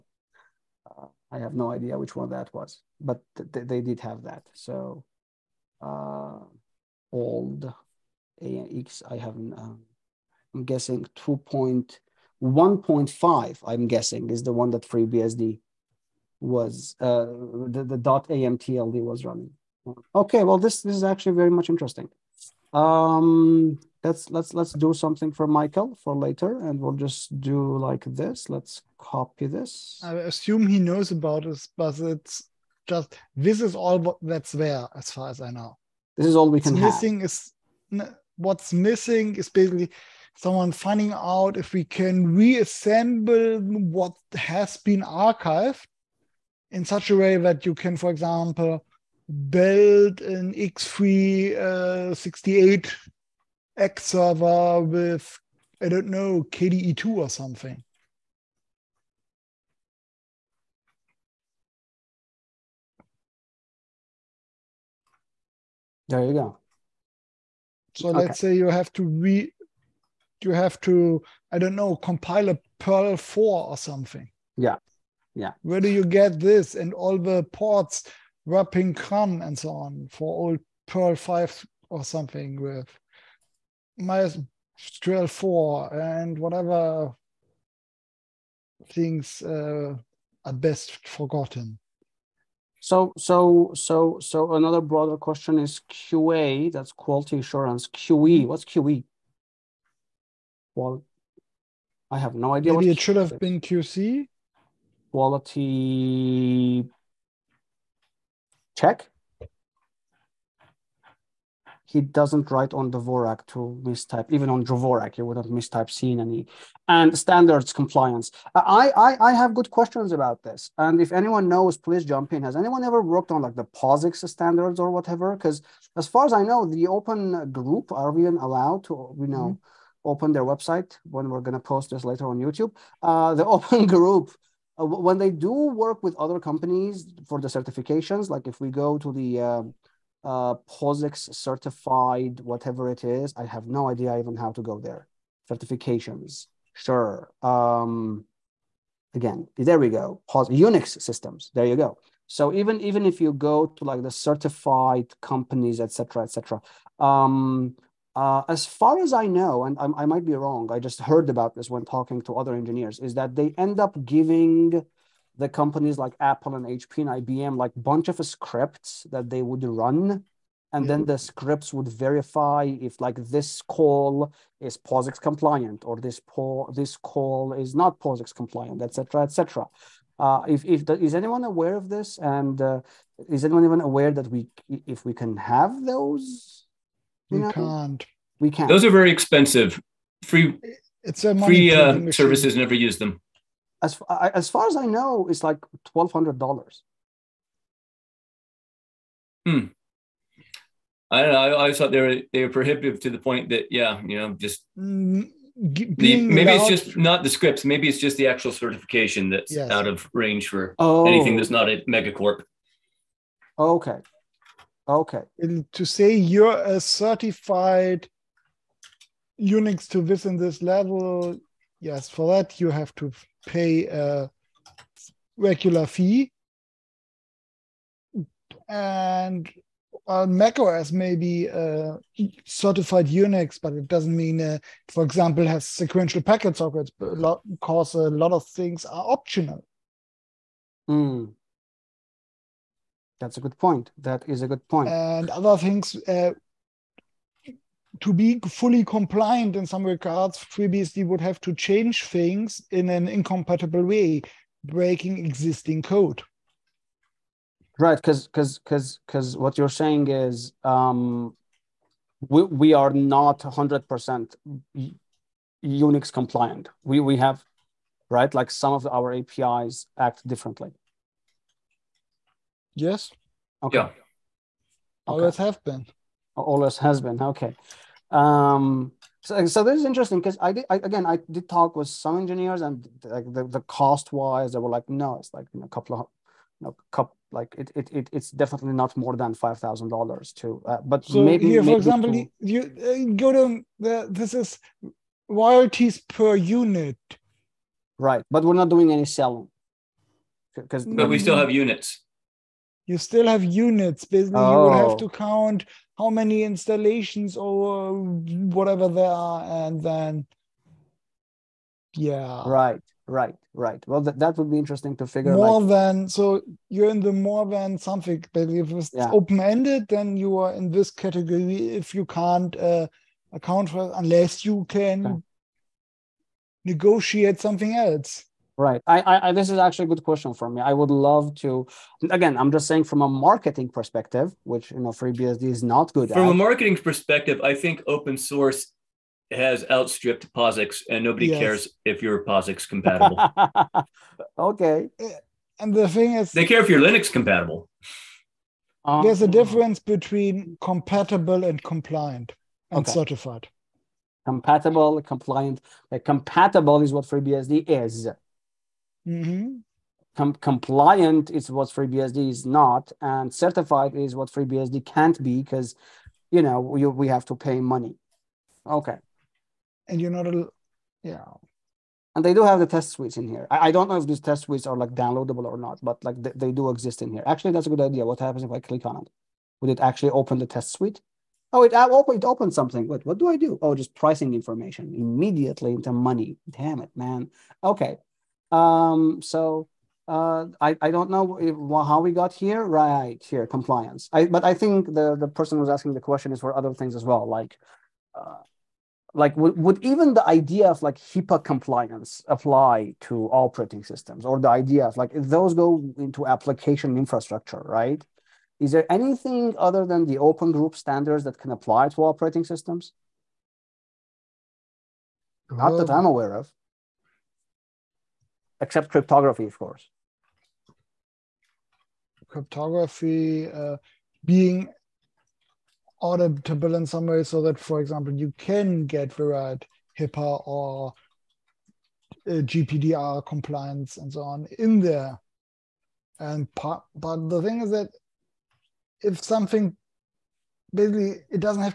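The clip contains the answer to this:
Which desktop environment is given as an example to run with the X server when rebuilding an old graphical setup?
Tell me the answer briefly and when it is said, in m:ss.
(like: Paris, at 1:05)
KDE2, at 0:56.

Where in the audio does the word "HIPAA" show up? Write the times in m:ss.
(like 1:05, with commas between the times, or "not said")
6:40, 7:09.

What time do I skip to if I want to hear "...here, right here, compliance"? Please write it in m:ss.
6:32.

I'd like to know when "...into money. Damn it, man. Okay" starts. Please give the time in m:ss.
6:25.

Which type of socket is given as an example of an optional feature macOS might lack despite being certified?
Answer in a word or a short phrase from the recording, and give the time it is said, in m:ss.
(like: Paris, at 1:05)
Sequential packet sockets, at 3:55.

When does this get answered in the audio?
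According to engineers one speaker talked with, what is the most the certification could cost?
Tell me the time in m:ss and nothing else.
4:49.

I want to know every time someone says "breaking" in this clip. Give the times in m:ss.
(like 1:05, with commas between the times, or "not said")
4:14.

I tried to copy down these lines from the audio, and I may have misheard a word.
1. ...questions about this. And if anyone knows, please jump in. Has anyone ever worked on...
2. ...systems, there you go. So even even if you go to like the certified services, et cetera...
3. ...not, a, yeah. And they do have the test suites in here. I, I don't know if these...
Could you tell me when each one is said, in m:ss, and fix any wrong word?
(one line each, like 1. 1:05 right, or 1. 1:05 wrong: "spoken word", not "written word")
1. 1:59 right
2. 2:31 wrong: "companies", not "services"
3. 6:10 right.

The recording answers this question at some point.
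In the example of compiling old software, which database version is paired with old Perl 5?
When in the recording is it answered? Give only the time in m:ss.
1:23.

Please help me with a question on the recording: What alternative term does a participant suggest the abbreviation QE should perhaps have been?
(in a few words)
QC.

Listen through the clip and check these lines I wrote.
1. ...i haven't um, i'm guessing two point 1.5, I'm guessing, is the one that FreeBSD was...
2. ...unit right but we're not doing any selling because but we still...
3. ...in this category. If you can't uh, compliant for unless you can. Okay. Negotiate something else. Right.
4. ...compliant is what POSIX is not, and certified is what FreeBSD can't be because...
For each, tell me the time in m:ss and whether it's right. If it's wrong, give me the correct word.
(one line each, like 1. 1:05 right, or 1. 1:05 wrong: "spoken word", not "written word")
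1. 0:09 right
2. 4:56 right
3. 5:20 wrong: "account", not "compliant"
4. 6:00 wrong: "FreeBSD", not "POSIX".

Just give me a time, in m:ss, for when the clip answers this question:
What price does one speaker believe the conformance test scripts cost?
3:15.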